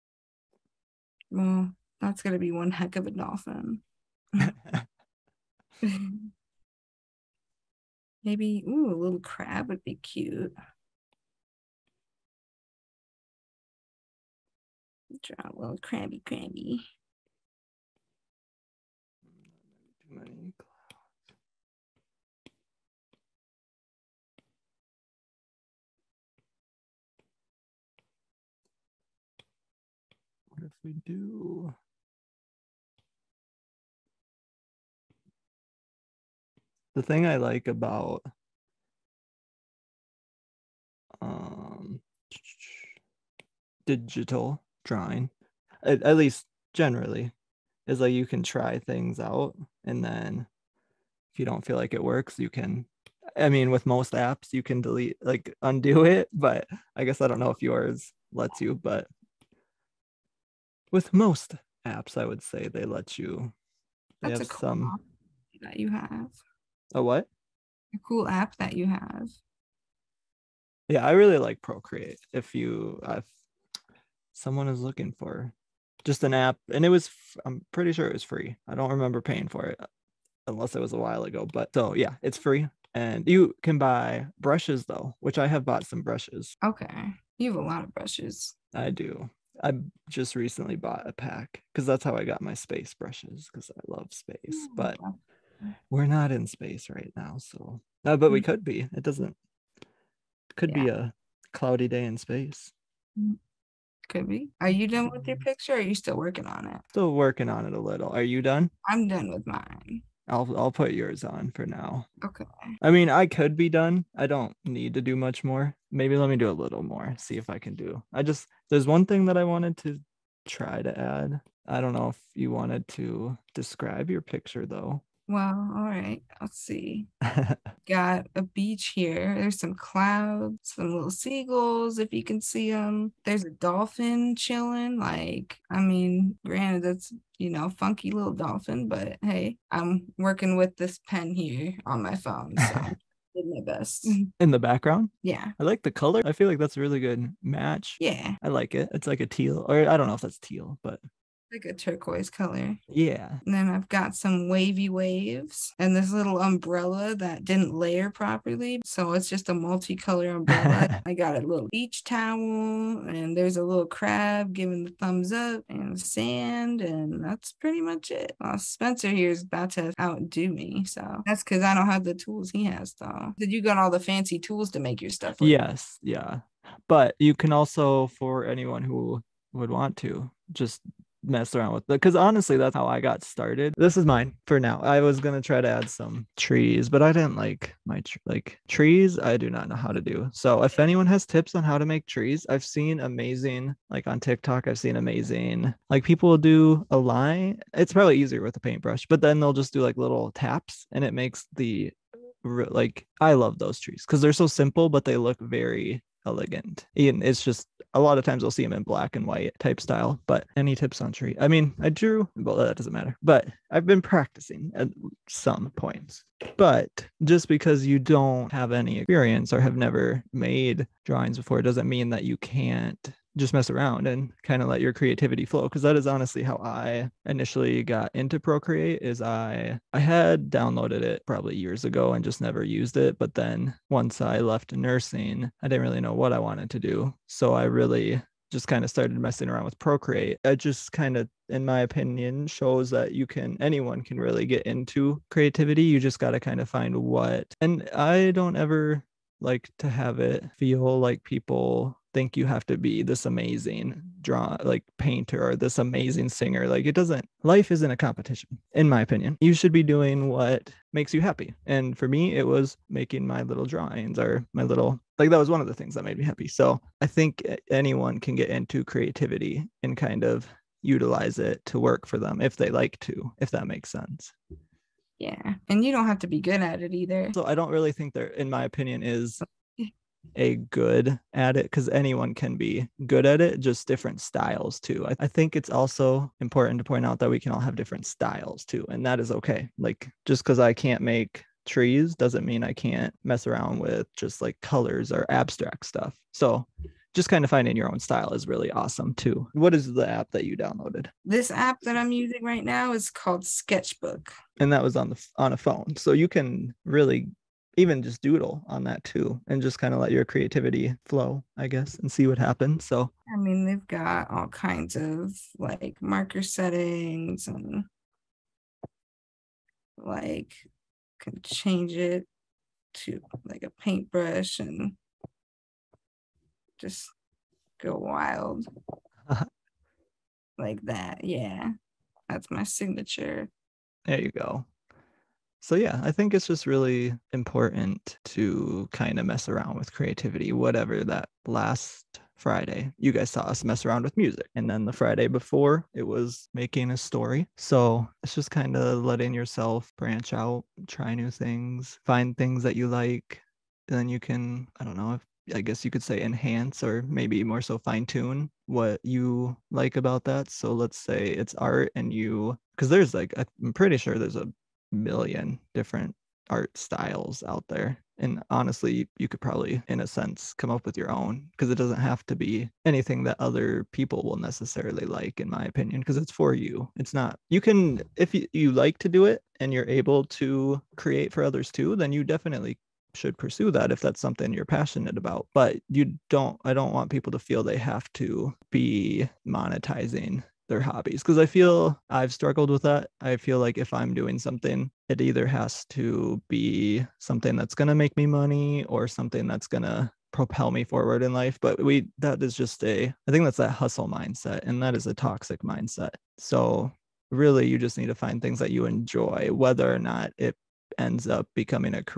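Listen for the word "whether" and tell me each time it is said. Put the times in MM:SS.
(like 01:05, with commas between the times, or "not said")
06:49.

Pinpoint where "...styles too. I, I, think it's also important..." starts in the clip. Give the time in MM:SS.
04:44.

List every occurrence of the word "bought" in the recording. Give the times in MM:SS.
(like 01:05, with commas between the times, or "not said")
01:25, 01:30.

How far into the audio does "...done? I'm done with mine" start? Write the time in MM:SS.
01:48.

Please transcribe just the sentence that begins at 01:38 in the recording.
could be it doesn't could yeah.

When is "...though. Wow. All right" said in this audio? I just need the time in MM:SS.
02:04.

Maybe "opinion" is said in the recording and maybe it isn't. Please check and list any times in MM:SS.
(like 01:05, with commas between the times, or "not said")
04:01, 04:19, 04:38, 06:15.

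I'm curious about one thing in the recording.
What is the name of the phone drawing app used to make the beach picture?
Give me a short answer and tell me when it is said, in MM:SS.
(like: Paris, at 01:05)
Sketchbook, at 05:03.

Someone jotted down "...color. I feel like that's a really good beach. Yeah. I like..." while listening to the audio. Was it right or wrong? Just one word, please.
wrong.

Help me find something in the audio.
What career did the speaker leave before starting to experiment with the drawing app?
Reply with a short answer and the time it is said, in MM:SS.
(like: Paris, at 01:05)
Nursing, at 03:54.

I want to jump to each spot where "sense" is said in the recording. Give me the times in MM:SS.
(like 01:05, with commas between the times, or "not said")
04:33, 06:10.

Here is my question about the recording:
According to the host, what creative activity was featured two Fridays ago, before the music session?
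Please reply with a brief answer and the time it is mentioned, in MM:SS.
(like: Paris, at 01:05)
Making a story, at 05:46.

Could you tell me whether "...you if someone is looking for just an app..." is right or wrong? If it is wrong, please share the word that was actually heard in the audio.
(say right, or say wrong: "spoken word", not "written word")
right.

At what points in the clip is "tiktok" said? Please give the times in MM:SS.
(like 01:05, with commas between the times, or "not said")
03:14.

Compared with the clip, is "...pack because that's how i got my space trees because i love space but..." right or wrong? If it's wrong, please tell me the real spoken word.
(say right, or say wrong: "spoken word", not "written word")
wrong: "brushes", not "trees".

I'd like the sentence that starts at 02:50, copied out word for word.
So that's because I don't have the tools he has though.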